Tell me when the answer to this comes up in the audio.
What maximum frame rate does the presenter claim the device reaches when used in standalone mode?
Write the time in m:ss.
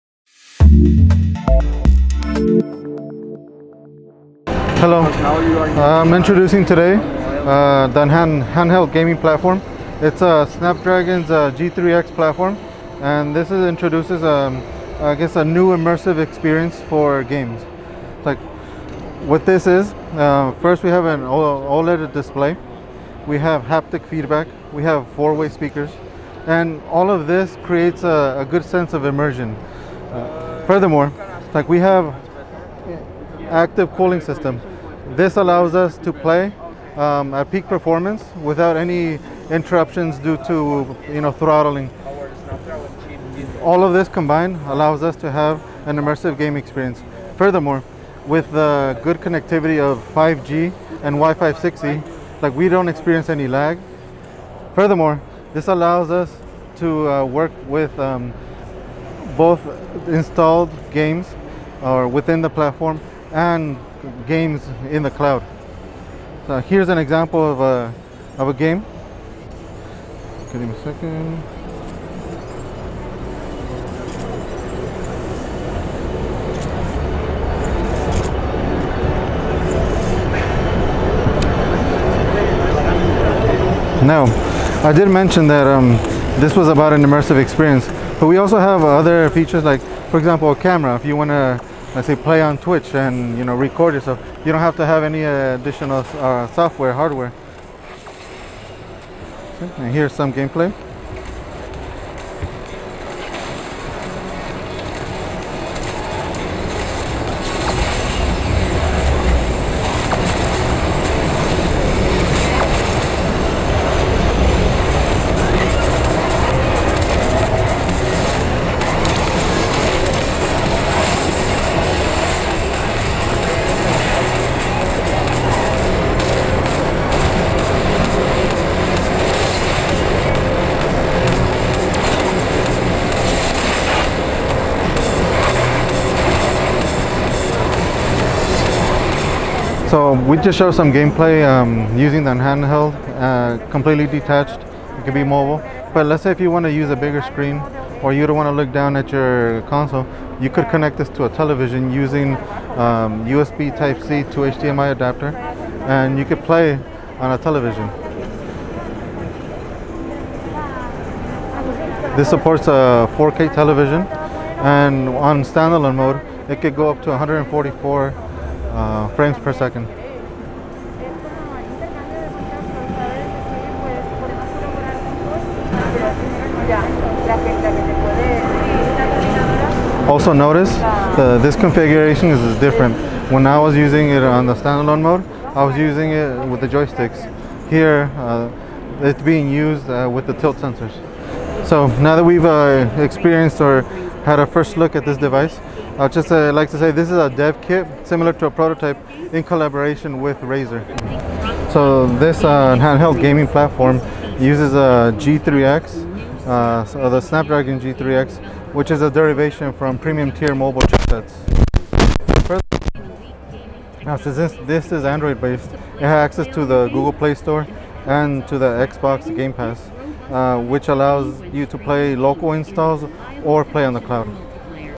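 2:47.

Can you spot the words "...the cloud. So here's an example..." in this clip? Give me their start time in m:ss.
1:05.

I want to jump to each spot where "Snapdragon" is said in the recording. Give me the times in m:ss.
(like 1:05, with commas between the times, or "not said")
0:10, 3:27.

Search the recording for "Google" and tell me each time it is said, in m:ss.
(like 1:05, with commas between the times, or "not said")
3:36.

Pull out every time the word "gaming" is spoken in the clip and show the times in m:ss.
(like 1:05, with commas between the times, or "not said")
0:08, 3:23.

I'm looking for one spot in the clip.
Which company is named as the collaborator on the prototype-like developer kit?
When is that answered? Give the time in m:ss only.
3:20.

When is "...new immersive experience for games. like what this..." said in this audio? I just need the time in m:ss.
0:15.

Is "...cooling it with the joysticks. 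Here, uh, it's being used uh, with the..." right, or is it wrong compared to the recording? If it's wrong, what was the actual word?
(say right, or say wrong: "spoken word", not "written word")
wrong: "using", not "cooling".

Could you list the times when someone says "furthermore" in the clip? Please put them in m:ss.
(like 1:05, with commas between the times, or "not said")
0:30, 0:47, 0:54.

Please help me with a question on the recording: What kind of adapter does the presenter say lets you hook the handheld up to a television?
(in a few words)
USB Type-C to HDMI.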